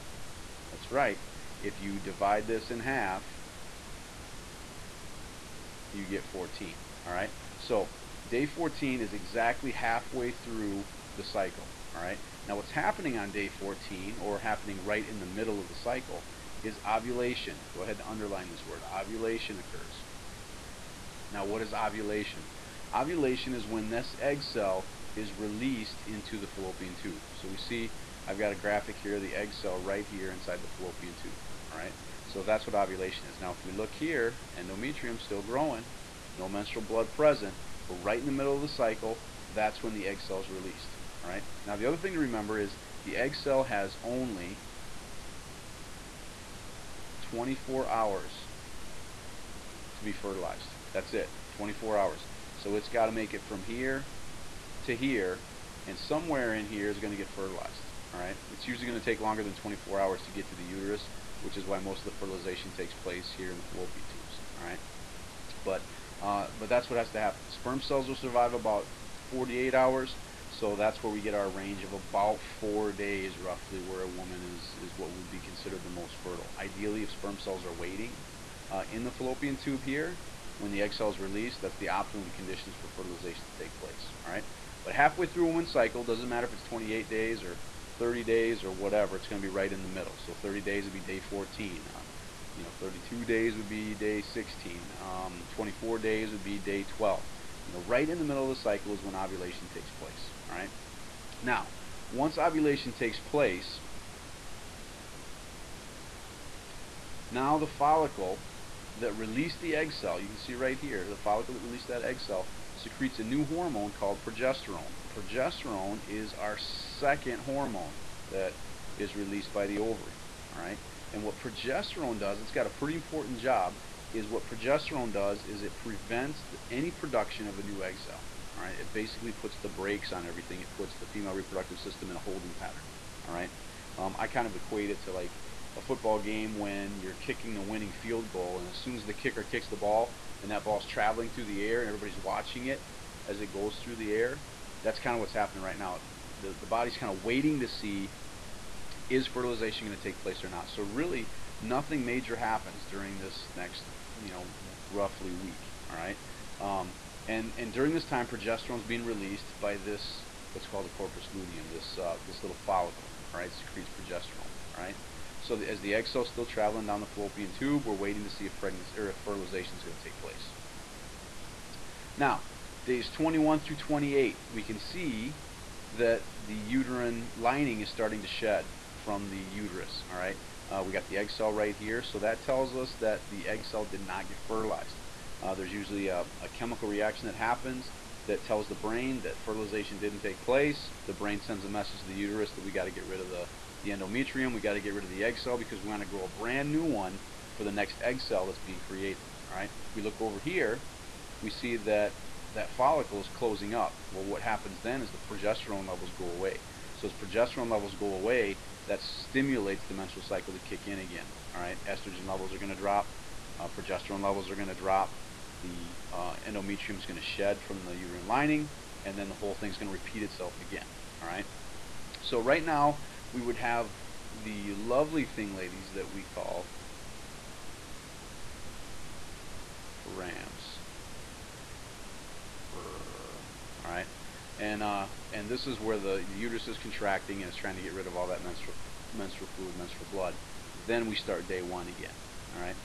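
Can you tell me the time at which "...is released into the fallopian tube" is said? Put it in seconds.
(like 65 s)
25 s.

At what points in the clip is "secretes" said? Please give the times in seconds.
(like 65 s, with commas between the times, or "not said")
112 s, 163 s.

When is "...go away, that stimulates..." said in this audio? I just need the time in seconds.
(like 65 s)
207 s.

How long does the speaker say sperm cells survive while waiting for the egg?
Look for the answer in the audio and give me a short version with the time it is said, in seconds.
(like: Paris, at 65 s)
48 hours, at 69 s.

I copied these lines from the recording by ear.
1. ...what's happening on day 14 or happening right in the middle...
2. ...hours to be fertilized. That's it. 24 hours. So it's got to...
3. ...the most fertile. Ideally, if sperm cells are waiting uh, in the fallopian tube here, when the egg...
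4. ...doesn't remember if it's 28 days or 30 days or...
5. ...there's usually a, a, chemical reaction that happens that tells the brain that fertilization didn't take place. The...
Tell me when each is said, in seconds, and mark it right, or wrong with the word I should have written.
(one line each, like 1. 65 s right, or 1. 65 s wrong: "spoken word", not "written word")
1. 12 s right
2. 47 s right
3. 75 s right
4. 86 s wrong: "matter", not "remember"
5. 185 s right.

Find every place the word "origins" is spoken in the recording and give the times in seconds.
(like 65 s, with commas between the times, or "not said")
not said.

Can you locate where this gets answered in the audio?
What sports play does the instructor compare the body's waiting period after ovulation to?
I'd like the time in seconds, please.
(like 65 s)
137 s.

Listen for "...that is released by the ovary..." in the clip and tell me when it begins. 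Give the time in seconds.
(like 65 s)
118 s.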